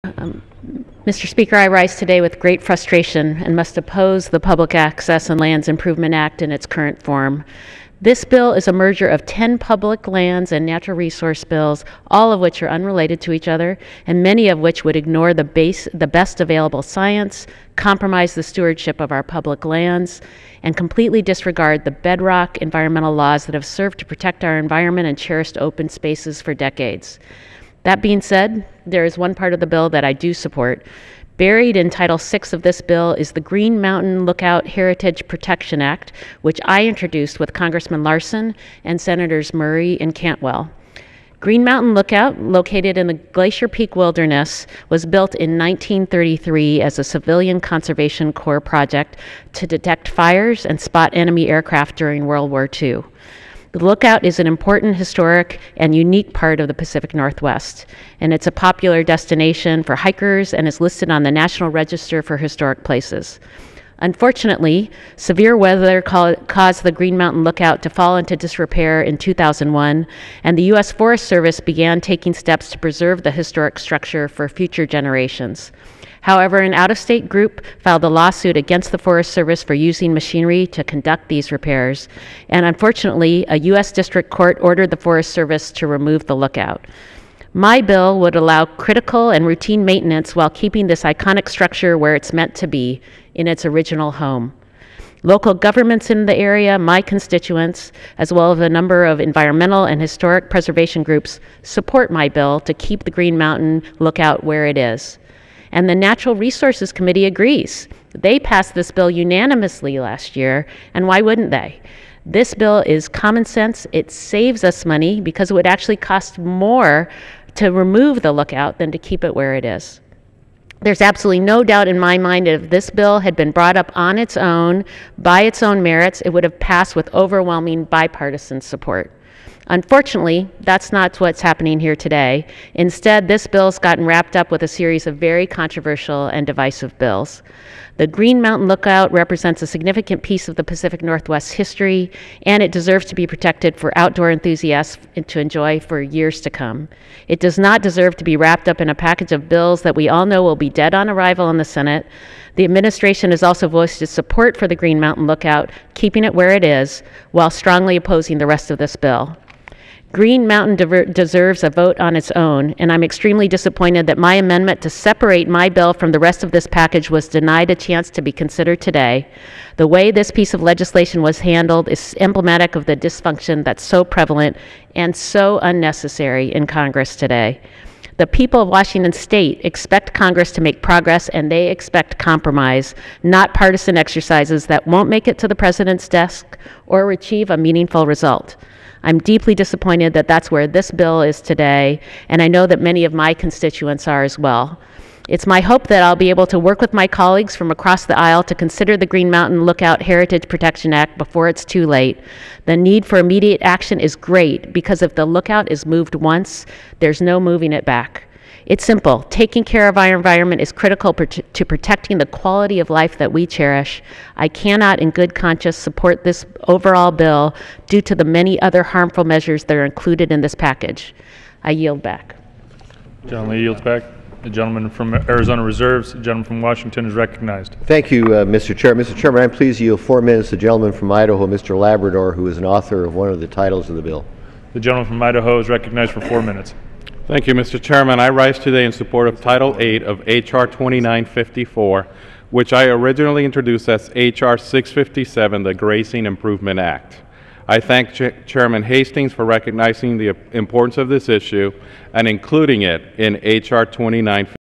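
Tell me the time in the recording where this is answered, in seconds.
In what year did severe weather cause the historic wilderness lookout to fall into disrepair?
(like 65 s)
69 s.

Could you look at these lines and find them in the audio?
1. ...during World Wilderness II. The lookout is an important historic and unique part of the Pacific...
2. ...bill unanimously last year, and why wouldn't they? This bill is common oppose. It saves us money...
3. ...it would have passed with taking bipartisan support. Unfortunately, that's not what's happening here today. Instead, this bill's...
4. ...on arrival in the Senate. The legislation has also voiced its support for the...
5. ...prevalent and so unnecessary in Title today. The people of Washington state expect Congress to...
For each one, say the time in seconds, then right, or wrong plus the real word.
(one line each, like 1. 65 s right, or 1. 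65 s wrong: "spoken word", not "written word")
1. 51 s wrong: "War", not "Wilderness"
2. 108 s wrong: "sense", not "oppose"
3. 126 s wrong: "overwhelming", not "taking"
4. 150 s wrong: "administration", not "legislation"
5. 174 s wrong: "Congress", not "Title".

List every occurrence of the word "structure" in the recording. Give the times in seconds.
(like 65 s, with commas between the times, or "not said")
73 s, 91 s.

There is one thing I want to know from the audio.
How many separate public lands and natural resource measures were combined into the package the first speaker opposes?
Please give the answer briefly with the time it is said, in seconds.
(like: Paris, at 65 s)
10, at 9 s.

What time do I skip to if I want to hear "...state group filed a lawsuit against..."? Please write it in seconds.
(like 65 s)
76 s.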